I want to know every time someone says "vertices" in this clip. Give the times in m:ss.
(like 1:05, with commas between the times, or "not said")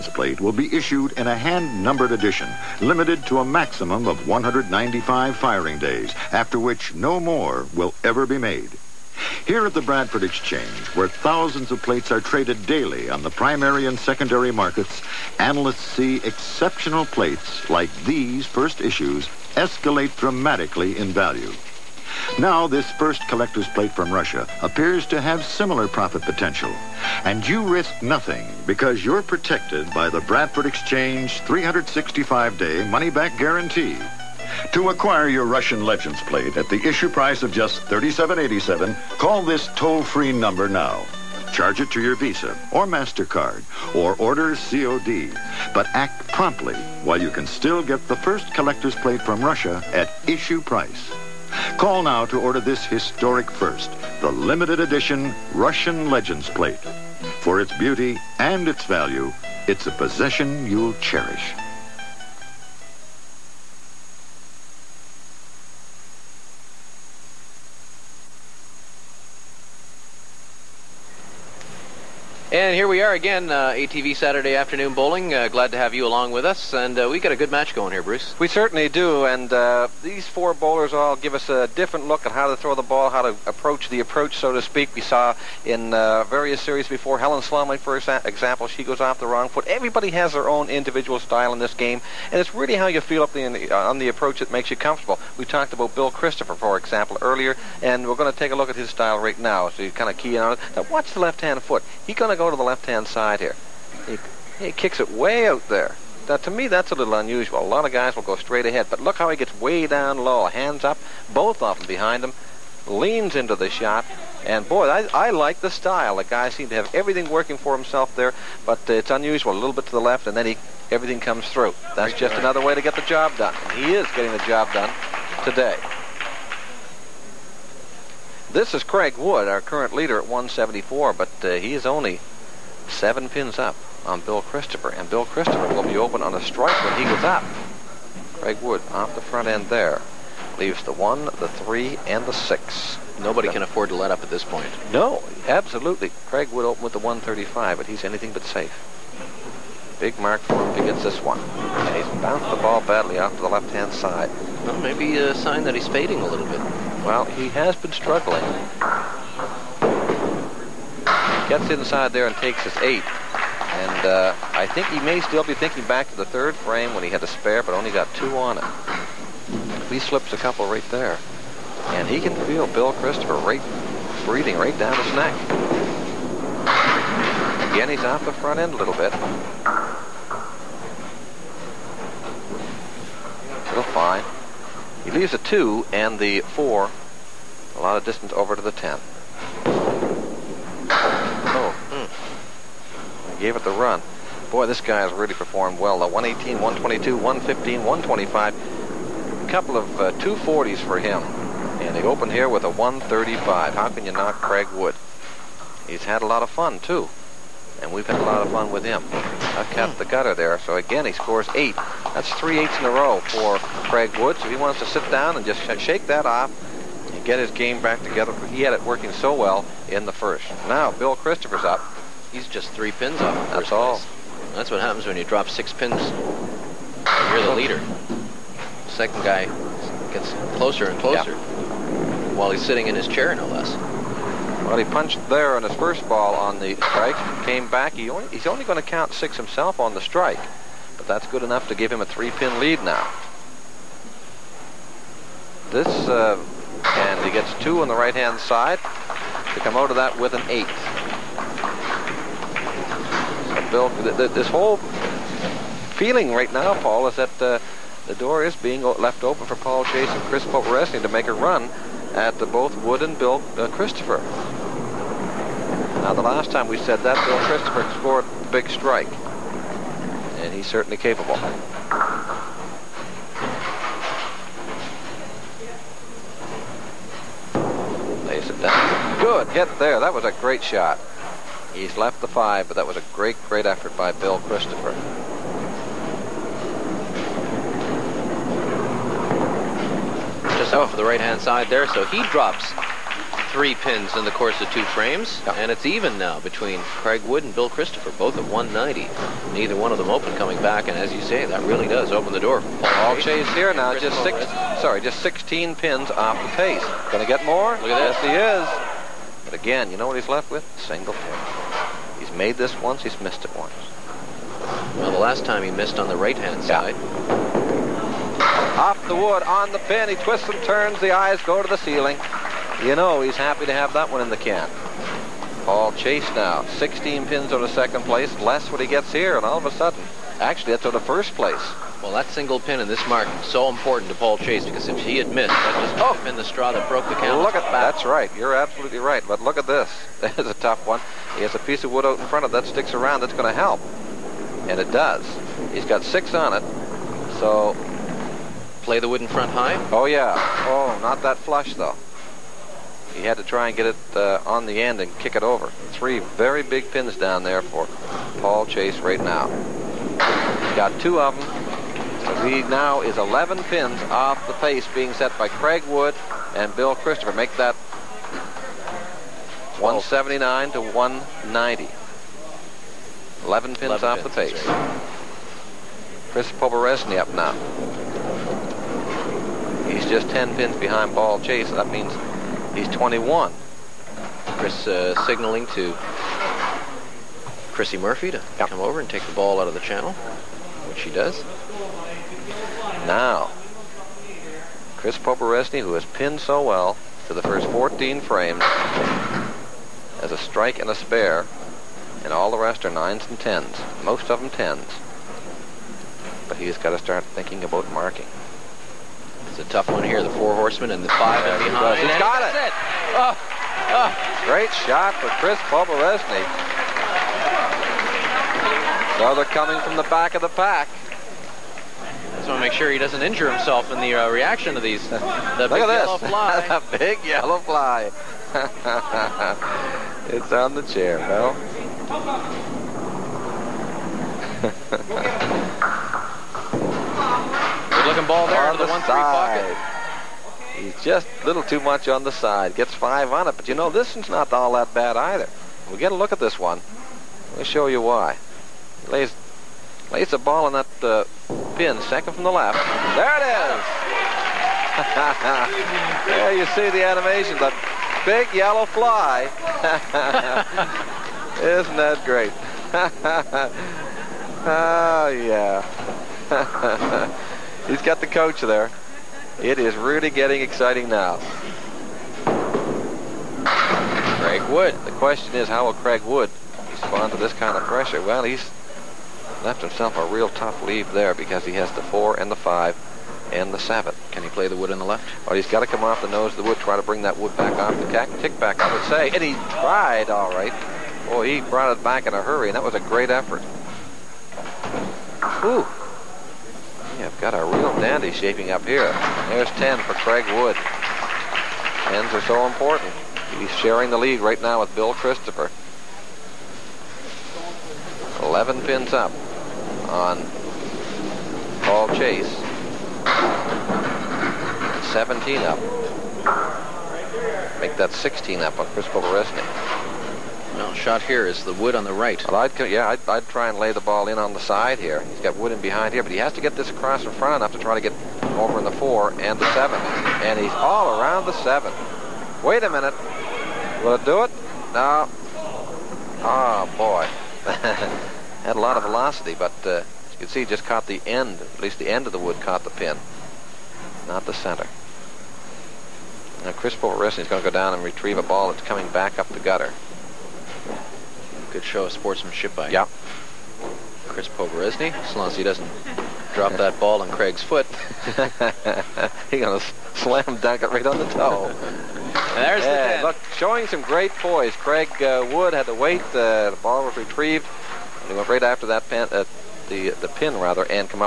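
not said.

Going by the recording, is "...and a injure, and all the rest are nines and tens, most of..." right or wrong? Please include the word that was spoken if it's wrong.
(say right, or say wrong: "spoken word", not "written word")
wrong: "spare", not "injure".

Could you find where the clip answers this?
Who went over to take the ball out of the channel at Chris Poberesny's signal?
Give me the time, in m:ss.
6:27.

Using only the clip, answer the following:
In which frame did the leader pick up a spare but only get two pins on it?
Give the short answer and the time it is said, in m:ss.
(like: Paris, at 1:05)
third, at 2:46.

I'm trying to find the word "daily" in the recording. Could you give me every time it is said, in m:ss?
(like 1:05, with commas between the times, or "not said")
0:12.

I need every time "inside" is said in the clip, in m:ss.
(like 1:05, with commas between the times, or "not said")
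2:41.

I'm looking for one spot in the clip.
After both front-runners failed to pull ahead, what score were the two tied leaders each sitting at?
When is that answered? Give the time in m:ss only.
4:58.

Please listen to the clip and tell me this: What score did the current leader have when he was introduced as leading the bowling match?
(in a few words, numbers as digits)
174.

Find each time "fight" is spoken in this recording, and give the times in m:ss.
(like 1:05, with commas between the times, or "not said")
not said.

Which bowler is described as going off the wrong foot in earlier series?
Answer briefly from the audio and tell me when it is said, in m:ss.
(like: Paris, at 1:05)
Helen Slomley, at 1:27.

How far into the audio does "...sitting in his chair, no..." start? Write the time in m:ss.
3:52.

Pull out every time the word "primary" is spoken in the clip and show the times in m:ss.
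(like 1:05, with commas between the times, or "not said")
0:13.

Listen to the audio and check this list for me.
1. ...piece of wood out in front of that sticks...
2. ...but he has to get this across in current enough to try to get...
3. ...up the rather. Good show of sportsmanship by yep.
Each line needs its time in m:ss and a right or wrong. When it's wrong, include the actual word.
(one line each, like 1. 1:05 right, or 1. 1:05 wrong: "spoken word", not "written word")
1. 5:41 right
2. 8:46 wrong: "front", not "current"
3. 9:09 wrong: "gutter", not "rather".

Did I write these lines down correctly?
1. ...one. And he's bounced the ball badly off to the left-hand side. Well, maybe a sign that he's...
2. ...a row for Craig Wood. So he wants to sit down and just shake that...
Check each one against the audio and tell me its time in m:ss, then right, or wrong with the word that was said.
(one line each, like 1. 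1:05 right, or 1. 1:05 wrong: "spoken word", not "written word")
1. 2:31 right
2. 3:32 right.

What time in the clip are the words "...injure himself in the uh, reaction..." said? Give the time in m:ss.
7:03.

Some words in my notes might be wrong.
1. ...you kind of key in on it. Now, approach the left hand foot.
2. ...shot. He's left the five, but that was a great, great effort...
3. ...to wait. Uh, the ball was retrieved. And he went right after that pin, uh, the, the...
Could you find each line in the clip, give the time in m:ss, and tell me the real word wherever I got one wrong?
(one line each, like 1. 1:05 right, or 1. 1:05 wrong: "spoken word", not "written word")
1. 1:39 wrong: "watch", not "approach"
2. 4:40 right
3. 9:25 right.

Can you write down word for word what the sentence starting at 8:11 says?
Boy, he brought it back in a hurry, and that was a great effort.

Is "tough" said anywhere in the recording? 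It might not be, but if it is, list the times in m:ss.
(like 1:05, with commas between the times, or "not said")
5:40, 6:49, 8:00.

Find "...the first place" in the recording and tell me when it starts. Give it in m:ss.
5:30.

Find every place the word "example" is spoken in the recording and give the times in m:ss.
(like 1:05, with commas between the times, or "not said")
1:27, 1:36.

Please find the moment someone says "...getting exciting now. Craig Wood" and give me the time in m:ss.
7:50.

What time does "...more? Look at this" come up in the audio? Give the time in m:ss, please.
5:07.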